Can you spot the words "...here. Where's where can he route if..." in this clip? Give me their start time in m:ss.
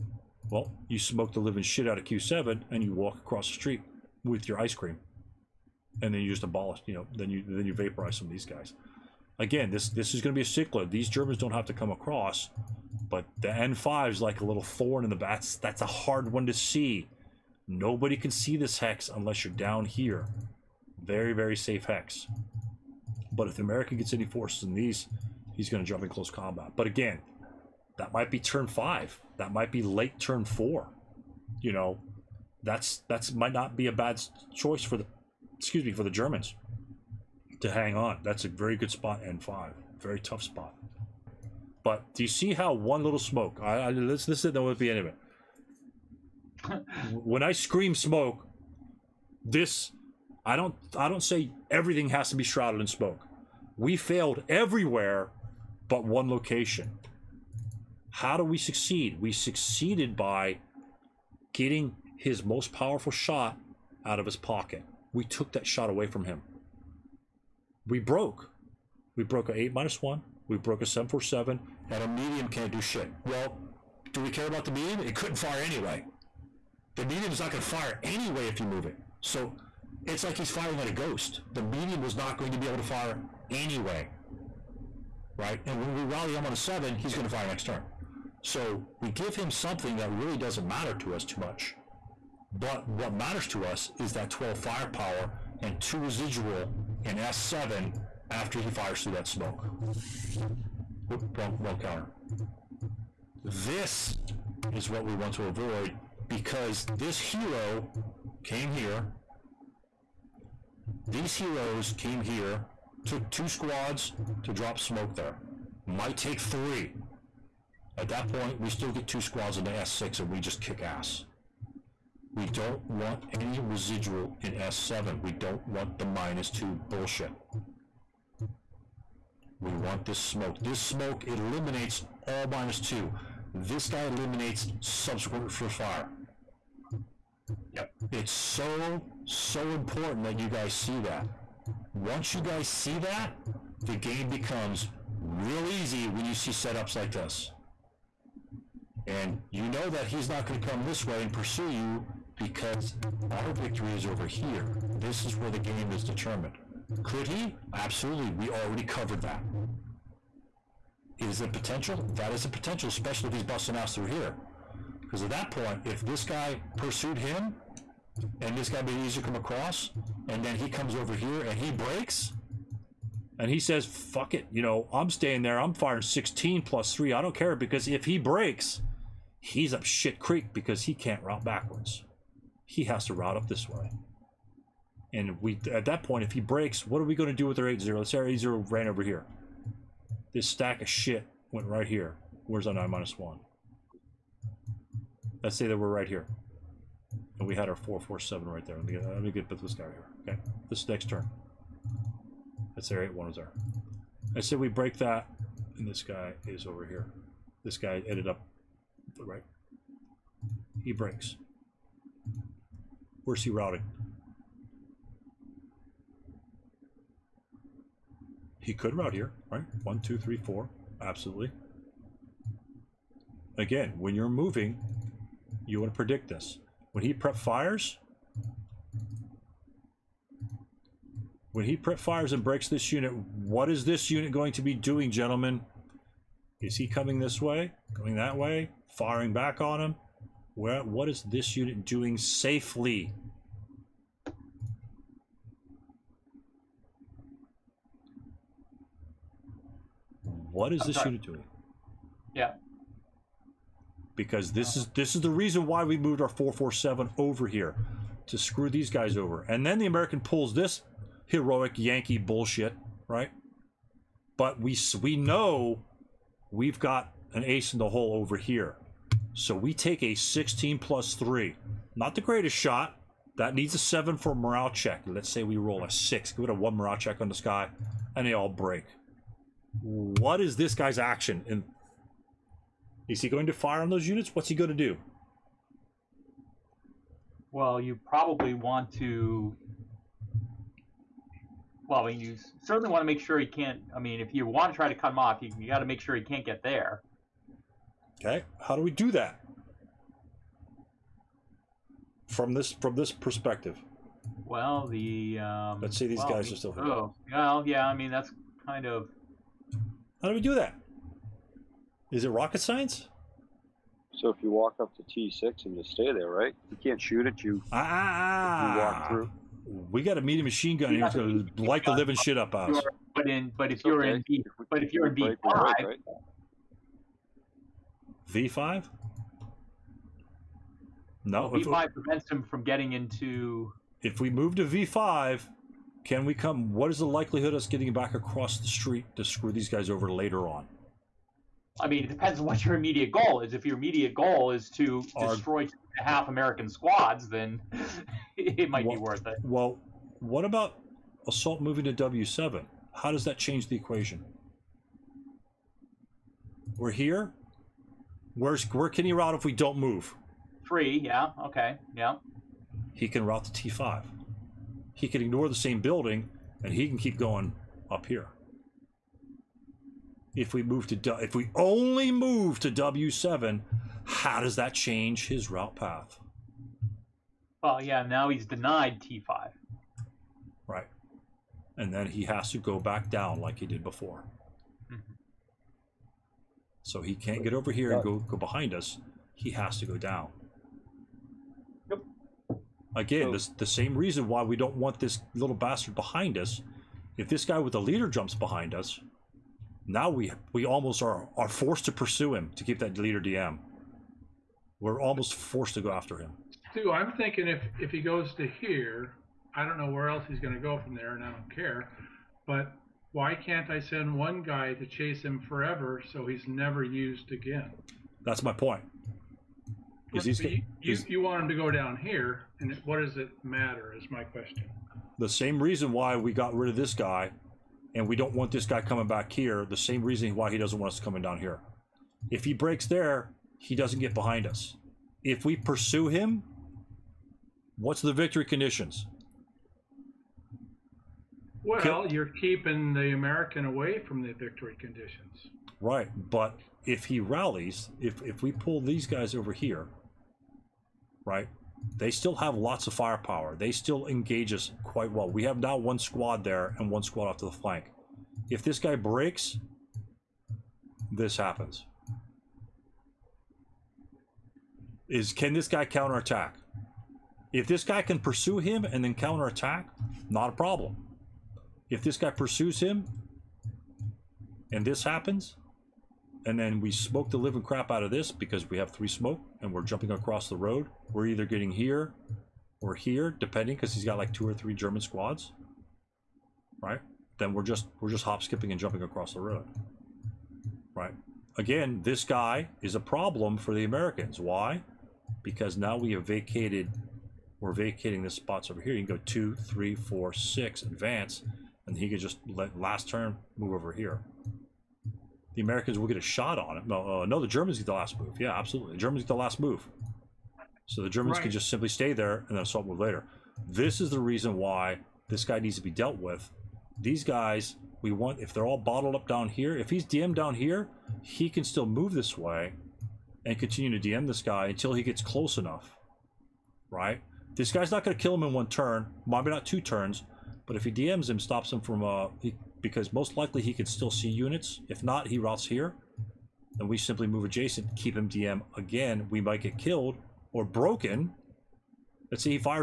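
5:56.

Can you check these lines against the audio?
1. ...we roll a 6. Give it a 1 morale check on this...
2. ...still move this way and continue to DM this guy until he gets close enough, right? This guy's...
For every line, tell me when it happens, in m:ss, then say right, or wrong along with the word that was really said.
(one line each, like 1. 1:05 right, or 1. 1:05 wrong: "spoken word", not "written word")
1. 4:35 right
2. 8:41 right.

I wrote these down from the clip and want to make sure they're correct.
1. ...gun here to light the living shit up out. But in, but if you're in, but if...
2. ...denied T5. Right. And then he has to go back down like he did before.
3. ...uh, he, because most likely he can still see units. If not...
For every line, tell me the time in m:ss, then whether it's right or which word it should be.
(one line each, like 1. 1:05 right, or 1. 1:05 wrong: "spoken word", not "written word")
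1. 5:20 right
2. 6:18 right
3. 8:52 right.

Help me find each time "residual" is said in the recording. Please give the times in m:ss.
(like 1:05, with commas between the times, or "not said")
1:35, 2:03.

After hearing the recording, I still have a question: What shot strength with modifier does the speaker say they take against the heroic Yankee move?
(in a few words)
16 plus 3.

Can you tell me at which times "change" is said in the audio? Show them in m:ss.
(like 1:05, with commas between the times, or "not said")
5:53, 6:14.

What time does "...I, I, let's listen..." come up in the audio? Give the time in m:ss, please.
0:43.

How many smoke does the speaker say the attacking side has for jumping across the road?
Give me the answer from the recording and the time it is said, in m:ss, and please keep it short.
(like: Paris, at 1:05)
3, at 7:58.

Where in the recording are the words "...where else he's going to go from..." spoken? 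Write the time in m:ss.
6:49.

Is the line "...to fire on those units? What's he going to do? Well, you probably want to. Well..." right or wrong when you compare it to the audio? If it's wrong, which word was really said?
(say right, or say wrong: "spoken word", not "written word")
right.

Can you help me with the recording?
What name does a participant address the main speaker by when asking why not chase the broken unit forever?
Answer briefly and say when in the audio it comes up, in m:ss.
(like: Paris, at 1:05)
Stew, at 6:46.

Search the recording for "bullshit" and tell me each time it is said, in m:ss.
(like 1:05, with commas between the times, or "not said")
2:06, 4:22.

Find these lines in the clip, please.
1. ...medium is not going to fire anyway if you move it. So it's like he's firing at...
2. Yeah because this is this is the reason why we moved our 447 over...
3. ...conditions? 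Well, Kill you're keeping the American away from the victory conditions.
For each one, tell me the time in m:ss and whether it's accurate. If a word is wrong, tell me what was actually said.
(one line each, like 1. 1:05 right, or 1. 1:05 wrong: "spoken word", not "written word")
1. 1:17 right
2. 4:12 right
3. 7:18 right.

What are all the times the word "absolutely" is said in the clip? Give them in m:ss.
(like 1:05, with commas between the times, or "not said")
2:37, 3:41, 8:28.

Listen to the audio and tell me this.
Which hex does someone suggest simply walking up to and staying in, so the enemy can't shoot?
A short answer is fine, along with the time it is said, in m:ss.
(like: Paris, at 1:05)
T6, at 5:15.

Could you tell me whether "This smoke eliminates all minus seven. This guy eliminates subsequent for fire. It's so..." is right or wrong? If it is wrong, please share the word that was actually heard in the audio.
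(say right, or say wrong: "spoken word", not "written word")
wrong: "two", not "seven".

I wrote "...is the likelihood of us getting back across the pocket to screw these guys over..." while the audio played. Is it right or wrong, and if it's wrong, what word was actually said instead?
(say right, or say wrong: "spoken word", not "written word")
wrong: "street", not "pocket".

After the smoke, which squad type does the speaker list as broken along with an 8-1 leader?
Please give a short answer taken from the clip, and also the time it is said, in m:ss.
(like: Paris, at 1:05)
747, at 1:10.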